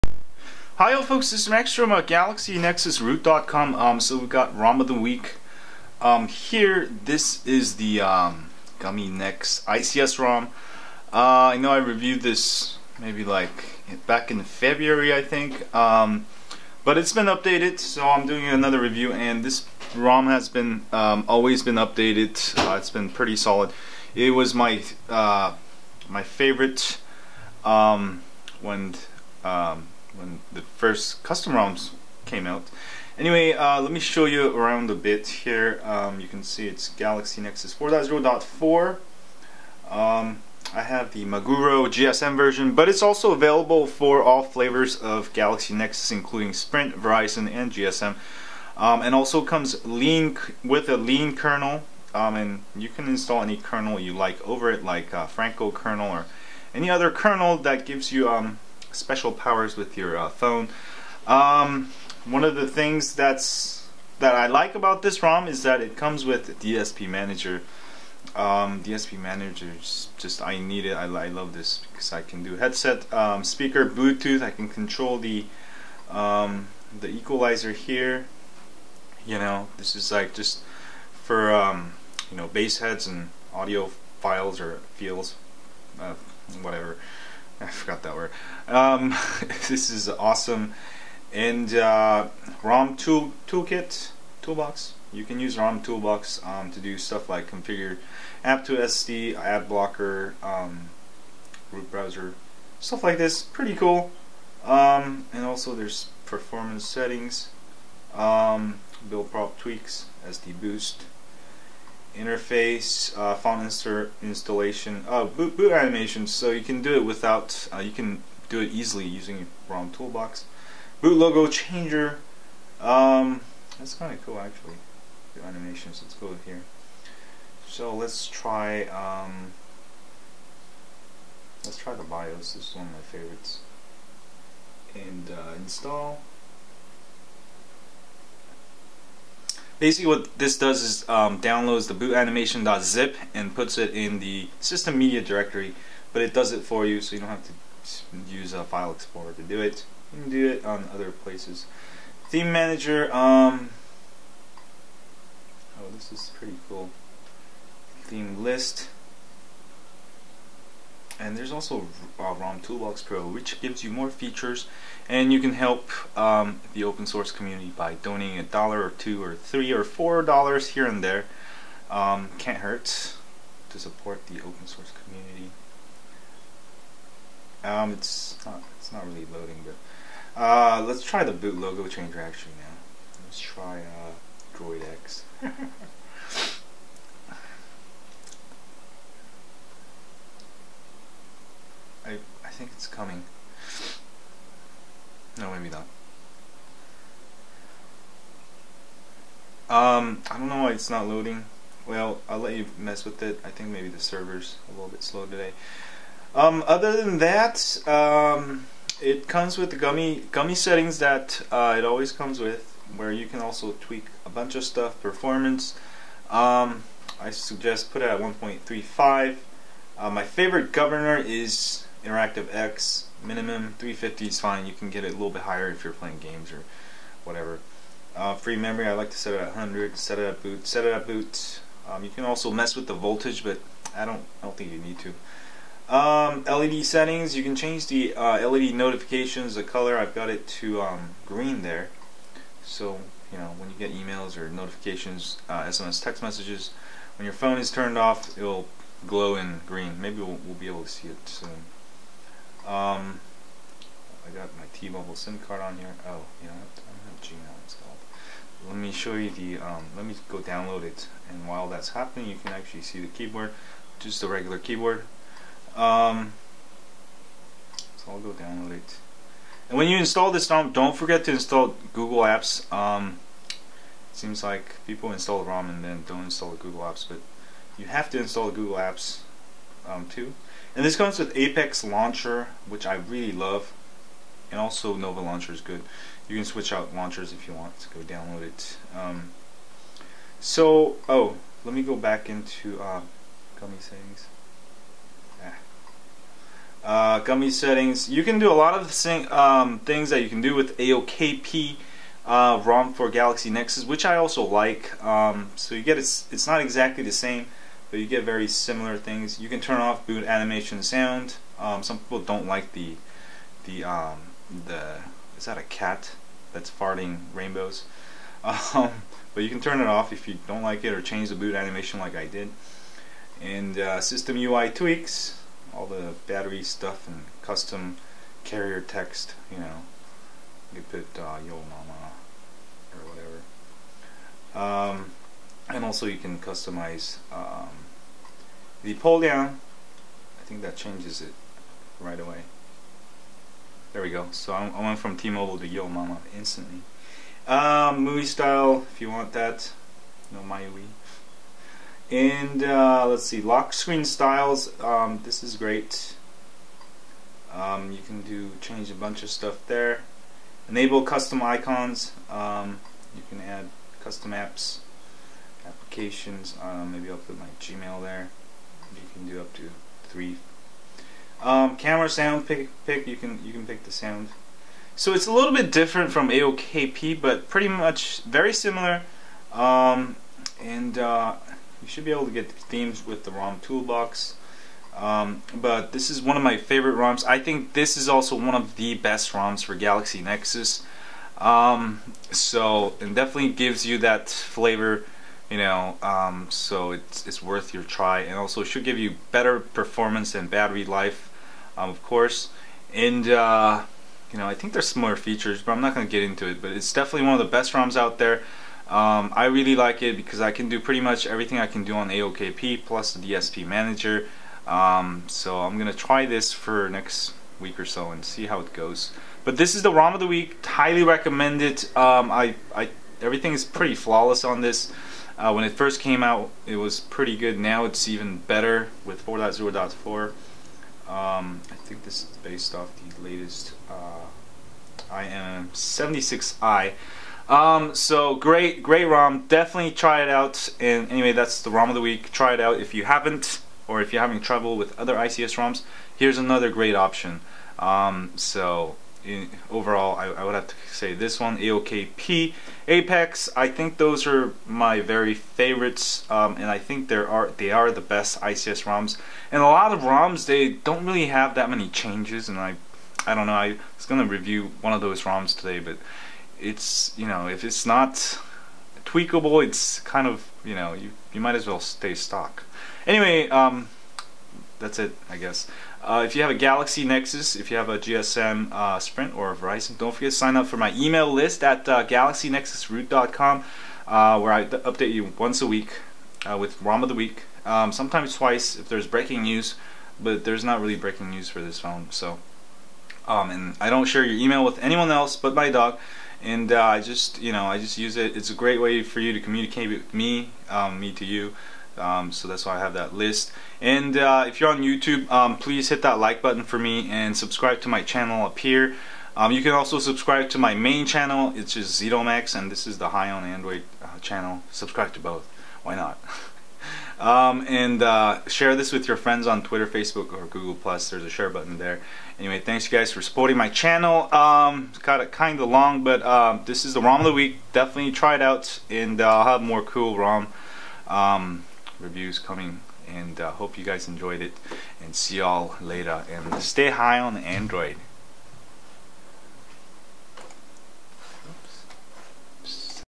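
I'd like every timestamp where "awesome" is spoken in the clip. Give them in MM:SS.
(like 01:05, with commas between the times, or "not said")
01:30.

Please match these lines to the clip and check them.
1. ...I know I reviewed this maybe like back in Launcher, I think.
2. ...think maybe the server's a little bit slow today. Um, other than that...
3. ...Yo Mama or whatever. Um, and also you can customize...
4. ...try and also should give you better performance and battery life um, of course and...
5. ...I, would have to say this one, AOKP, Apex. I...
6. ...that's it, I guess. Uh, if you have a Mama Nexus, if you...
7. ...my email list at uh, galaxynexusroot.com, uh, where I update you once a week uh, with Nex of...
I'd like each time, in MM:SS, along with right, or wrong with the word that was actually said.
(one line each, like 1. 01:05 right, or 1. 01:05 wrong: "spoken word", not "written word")
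1. 00:11 wrong: "February", not "Launcher"
2. 03:23 right
3. 05:31 right
4. 06:37 right
5. 07:30 right
6. 07:54 wrong: "Galaxy", not "Mama"
7. 08:00 wrong: "ROM", not "Nex".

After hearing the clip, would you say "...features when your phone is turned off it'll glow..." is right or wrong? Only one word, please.
wrong.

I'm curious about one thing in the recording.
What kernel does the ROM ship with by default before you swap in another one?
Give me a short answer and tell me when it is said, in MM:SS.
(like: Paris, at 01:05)
lean kernel, at 00:50.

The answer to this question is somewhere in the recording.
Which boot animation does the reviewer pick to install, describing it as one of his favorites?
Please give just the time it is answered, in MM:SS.
02:12.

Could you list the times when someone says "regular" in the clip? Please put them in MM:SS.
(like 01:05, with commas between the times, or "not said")
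04:24.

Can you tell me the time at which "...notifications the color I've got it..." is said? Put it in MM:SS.
03:58.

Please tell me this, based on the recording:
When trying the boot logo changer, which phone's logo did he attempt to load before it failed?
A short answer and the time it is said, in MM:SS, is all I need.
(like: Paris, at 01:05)
Droid X, at 03:04.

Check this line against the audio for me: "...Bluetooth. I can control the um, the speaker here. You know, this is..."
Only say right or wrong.
wrong.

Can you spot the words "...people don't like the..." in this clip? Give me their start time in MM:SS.
05:11.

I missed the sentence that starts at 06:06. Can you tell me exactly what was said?
Um, maybe I'll put my Gmail there.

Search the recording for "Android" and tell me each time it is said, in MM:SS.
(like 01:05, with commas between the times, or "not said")
08:33, 08:57.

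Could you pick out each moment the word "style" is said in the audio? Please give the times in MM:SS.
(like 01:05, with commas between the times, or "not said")
05:48, 05:54.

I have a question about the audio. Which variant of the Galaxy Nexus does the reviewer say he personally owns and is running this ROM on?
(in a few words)
Maguro GSM.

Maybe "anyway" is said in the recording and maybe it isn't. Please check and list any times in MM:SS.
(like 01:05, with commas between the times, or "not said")
00:33, 07:21, 07:53, 08:42.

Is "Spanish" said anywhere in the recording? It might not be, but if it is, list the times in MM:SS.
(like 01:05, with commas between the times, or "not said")
not said.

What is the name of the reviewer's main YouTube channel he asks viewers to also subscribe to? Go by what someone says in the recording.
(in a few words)
Zedomax.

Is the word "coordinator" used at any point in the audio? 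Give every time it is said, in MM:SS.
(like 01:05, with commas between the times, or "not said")
not said.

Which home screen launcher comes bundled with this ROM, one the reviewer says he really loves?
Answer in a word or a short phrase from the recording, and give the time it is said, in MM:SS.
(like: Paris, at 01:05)
Apex Launcher, at 04:41.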